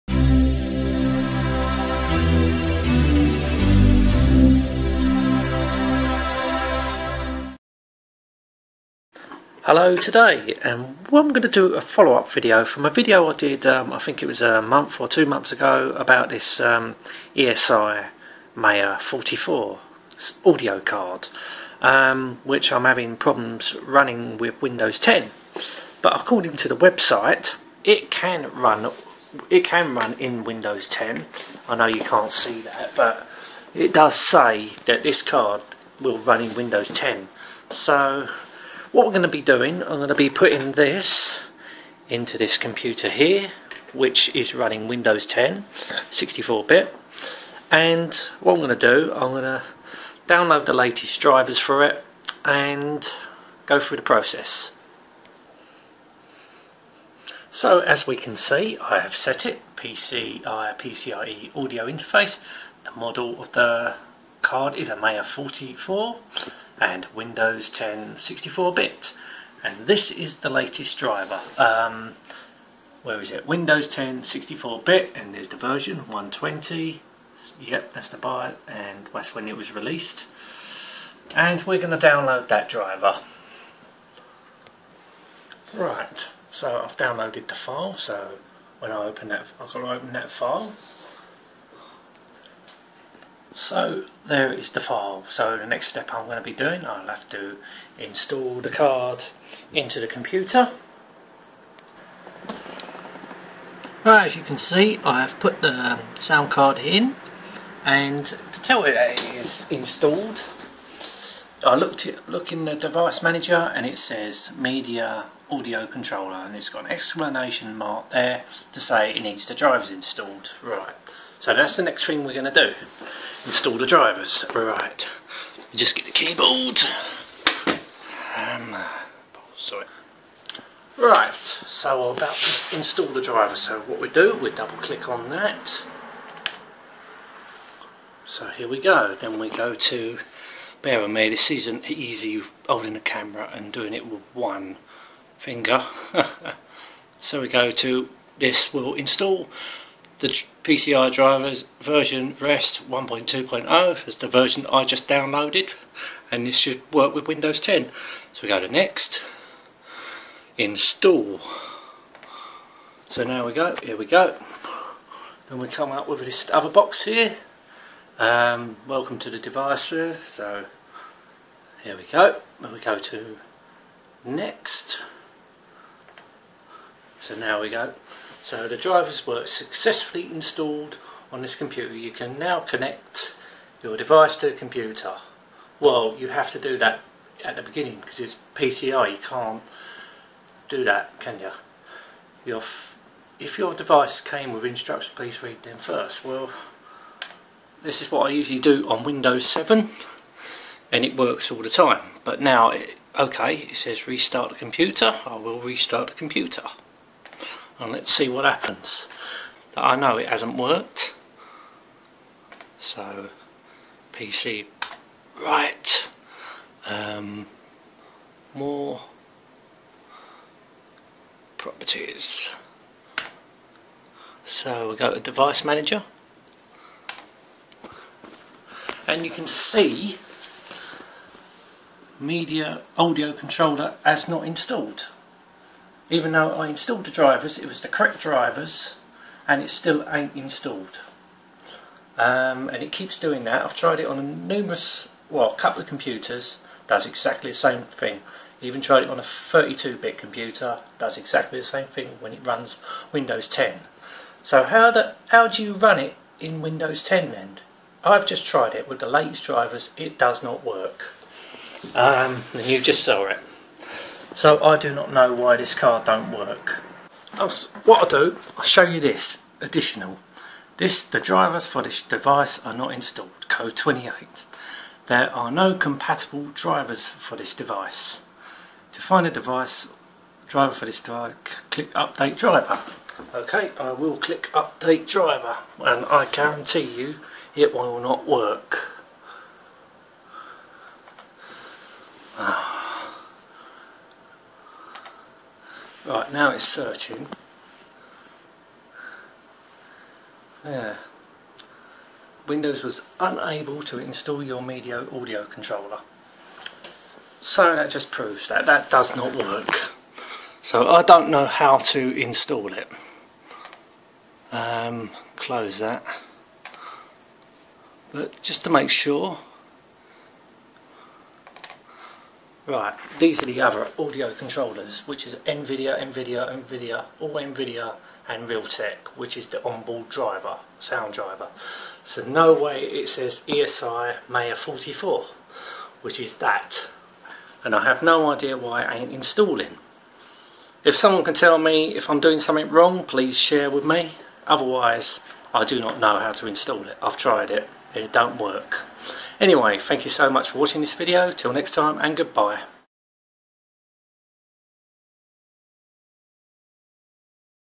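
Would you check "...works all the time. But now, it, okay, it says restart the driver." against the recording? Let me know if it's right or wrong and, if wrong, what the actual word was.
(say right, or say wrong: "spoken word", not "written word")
wrong: "computer", not "driver".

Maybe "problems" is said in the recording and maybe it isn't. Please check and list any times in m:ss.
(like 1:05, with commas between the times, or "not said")
0:23.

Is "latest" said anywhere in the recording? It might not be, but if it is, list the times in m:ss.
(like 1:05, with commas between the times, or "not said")
0:50, 1:10, 4:19.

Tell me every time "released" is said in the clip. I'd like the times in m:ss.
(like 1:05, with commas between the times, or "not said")
1:19.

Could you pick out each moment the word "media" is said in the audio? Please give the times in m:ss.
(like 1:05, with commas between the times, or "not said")
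1:54, 3:52, 5:04.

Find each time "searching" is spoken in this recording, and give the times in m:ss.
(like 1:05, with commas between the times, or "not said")
4:56.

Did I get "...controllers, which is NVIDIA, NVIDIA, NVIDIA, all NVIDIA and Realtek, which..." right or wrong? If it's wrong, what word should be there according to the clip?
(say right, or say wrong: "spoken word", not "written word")
right.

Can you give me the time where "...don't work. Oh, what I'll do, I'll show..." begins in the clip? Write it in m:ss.
4:26.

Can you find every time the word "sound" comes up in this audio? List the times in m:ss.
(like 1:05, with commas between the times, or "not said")
1:46, 5:30.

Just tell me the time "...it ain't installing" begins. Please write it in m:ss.
5:38.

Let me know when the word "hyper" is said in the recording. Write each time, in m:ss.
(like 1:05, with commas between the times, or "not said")
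not said.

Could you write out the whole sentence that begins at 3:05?
Well, you have to do that at the beginning because it's PCI.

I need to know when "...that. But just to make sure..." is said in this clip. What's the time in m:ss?
5:15.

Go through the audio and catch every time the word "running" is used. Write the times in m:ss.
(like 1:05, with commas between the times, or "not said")
0:23, 0:44.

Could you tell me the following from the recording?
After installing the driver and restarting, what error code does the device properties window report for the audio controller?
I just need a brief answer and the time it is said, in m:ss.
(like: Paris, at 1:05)
28, at 4:33.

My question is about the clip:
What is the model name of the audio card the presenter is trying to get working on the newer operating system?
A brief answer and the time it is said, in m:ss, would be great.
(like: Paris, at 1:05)
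Maya 44, at 1:02.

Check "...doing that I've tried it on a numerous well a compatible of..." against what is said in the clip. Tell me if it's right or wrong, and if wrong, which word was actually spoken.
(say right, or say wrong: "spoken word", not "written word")
wrong: "couple", not "compatible".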